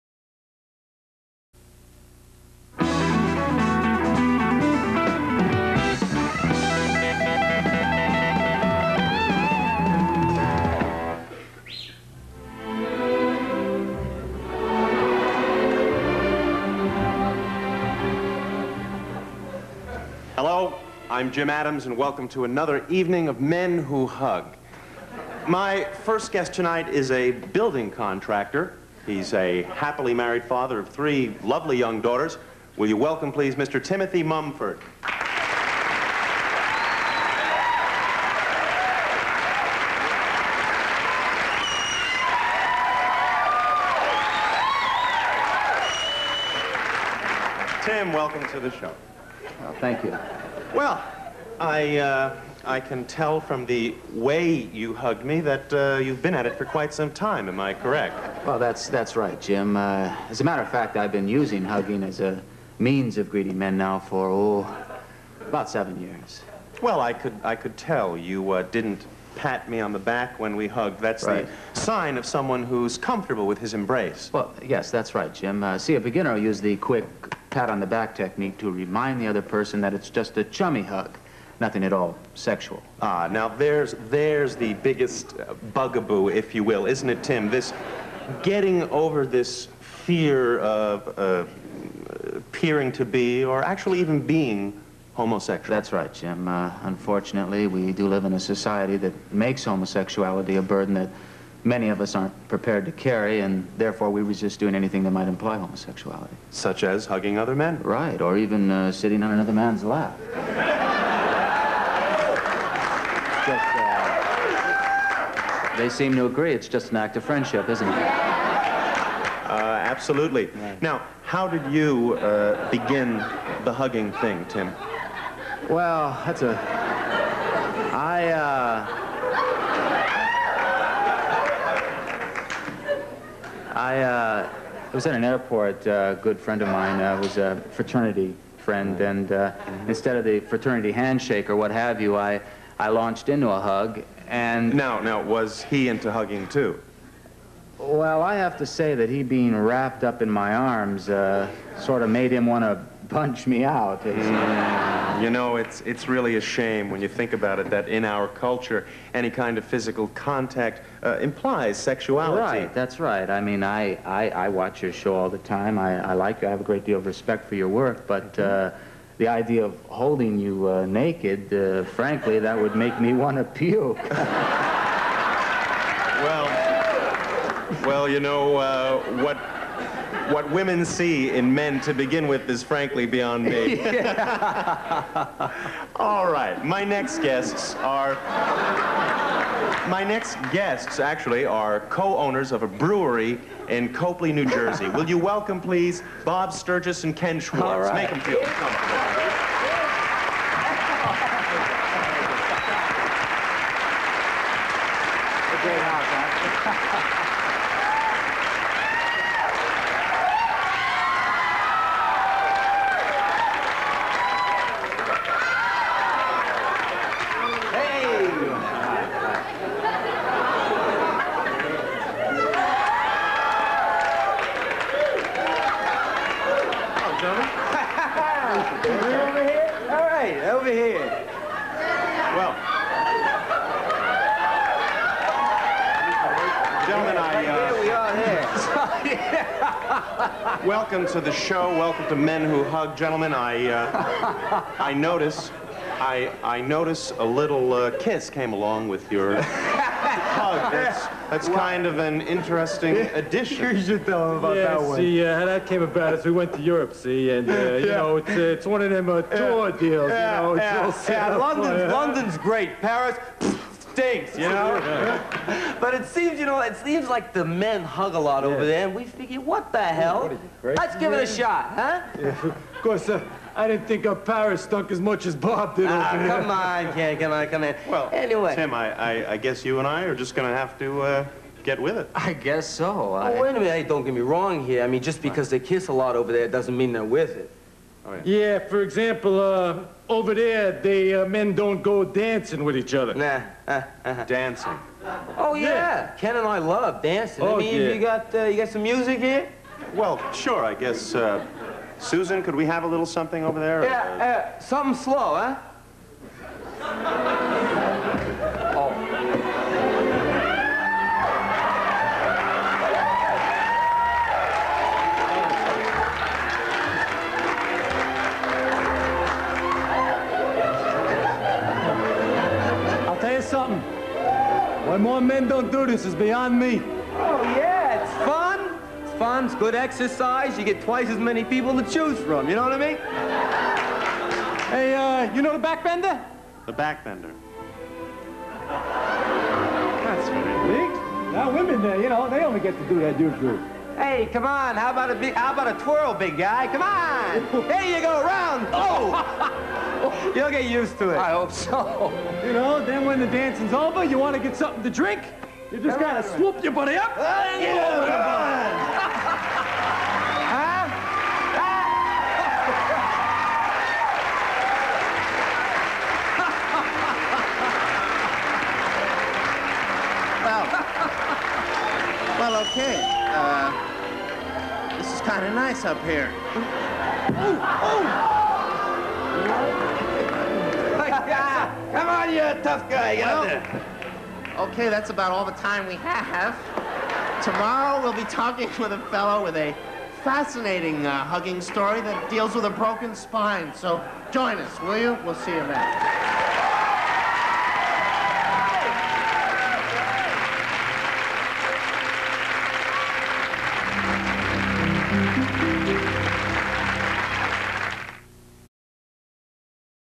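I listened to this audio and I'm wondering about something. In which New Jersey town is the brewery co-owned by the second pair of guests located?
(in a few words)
Copley.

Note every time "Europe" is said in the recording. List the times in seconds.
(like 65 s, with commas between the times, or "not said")
256 s.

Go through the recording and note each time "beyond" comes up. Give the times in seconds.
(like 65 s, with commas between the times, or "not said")
183 s, 326 s.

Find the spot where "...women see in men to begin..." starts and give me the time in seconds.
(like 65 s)
180 s.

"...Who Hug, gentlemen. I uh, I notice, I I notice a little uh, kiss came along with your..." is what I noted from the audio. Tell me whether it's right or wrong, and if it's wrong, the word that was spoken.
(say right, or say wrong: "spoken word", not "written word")
right.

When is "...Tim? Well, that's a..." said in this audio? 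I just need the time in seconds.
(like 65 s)
124 s.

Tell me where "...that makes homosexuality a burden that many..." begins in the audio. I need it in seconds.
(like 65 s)
98 s.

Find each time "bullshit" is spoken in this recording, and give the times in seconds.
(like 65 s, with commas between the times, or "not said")
not said.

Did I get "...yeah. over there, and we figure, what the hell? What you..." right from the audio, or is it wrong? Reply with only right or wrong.
right.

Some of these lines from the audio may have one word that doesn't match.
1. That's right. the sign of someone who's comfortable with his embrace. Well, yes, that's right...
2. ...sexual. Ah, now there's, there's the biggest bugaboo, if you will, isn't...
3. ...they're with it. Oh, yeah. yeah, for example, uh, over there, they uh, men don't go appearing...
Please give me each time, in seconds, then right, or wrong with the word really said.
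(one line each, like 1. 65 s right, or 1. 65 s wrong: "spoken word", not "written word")
1. 70 s right
2. 82 s right
3. 286 s wrong: "dancing", not "appearing".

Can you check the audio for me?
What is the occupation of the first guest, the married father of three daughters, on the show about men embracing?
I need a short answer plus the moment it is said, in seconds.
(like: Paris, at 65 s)
Building contractor, at 27 s.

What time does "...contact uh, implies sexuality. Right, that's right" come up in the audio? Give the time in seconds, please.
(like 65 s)
160 s.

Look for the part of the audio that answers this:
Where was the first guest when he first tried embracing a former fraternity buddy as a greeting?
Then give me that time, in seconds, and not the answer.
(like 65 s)
135 s.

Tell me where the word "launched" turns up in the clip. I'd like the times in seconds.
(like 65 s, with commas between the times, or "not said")
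142 s.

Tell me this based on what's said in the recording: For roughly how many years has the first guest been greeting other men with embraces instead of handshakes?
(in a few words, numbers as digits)
7.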